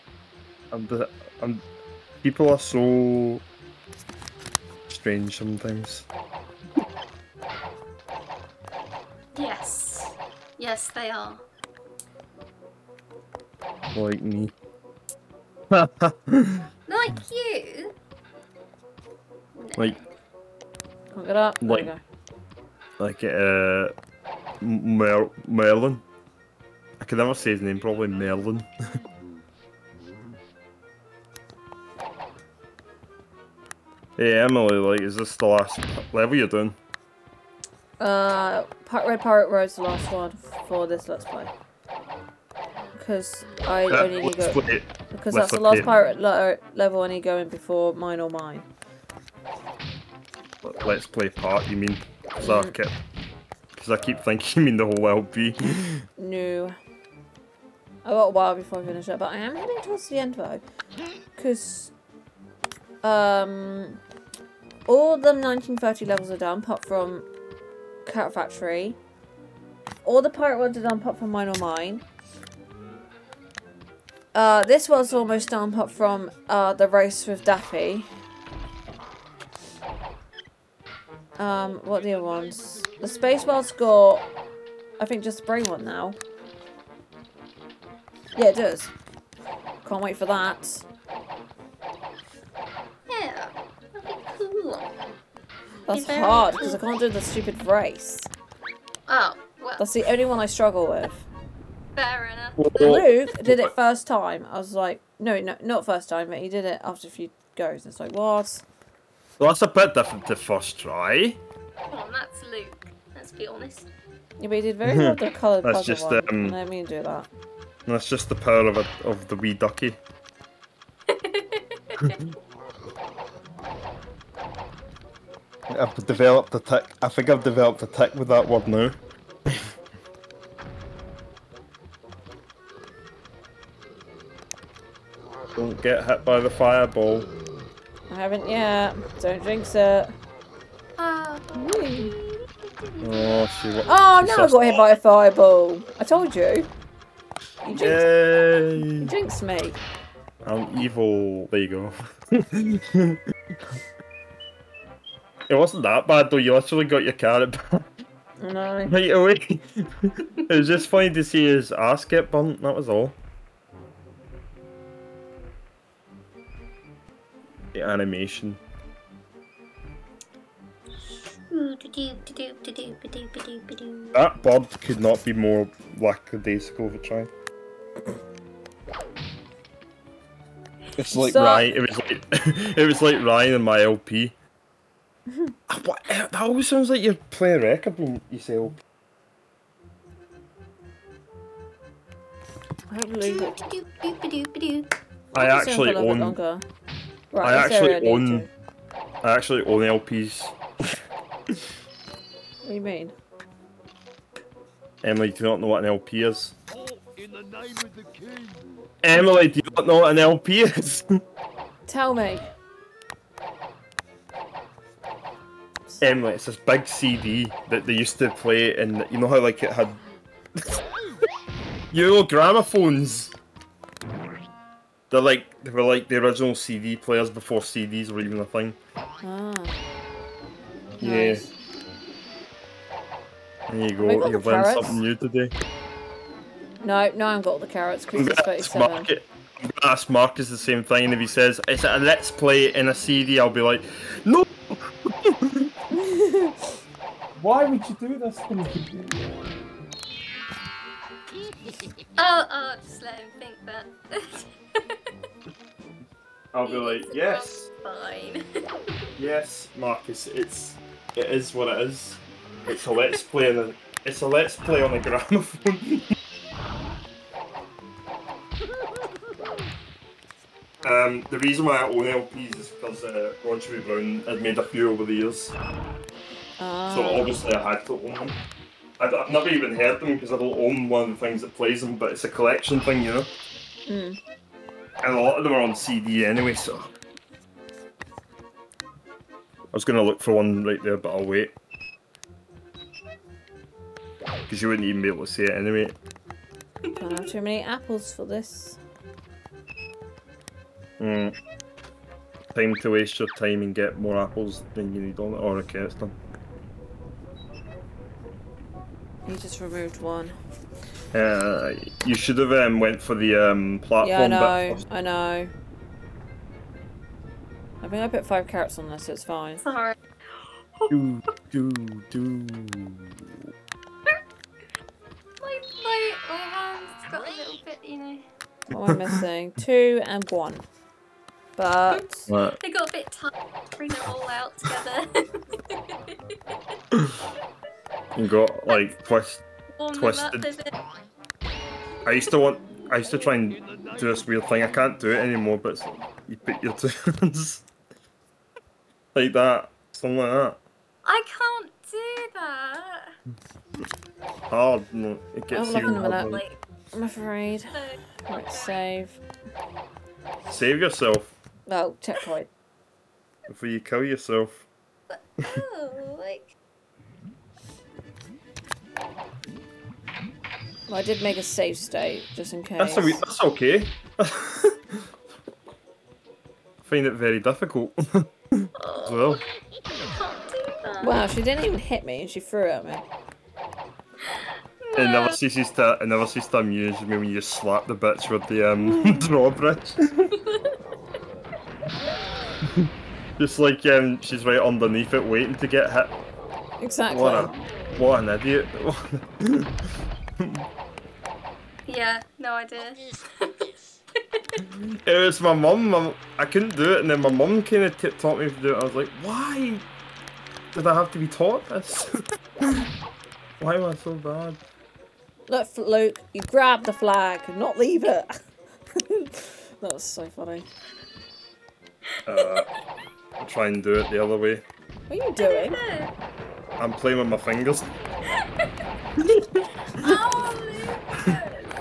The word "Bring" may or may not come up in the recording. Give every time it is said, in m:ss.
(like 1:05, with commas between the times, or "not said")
5:33.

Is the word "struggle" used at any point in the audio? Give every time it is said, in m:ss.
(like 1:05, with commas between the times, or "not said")
1:40.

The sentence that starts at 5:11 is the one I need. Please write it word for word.
Uh, you should have um, went for the um, platform.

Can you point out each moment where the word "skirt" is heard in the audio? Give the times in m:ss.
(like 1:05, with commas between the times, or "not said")
not said.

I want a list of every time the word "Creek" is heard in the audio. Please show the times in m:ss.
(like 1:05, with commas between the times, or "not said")
not said.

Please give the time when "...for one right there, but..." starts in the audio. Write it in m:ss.
4:50.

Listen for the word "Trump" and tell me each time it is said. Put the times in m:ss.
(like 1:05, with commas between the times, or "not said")
not said.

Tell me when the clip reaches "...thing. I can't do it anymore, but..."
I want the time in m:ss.
5:44.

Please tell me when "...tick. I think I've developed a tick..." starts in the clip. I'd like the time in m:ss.
2:06.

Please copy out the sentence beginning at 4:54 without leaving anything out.
Because you wouldn't even be able to see it anyway.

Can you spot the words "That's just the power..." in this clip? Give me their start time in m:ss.
1:57.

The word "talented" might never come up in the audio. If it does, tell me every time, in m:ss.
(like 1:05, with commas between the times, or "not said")
not said.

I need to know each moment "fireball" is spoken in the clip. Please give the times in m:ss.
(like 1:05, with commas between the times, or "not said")
2:16, 2:24.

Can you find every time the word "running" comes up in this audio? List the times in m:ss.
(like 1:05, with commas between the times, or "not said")
not said.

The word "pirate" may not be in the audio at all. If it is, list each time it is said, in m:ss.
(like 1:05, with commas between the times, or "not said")
0:39, 0:45, 1:10.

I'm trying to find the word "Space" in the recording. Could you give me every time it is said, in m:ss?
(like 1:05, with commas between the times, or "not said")
1:23.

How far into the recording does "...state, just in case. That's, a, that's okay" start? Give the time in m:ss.
6:11.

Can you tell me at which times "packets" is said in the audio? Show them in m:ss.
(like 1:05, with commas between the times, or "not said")
not said.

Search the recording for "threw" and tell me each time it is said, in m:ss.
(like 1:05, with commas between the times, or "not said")
6:22.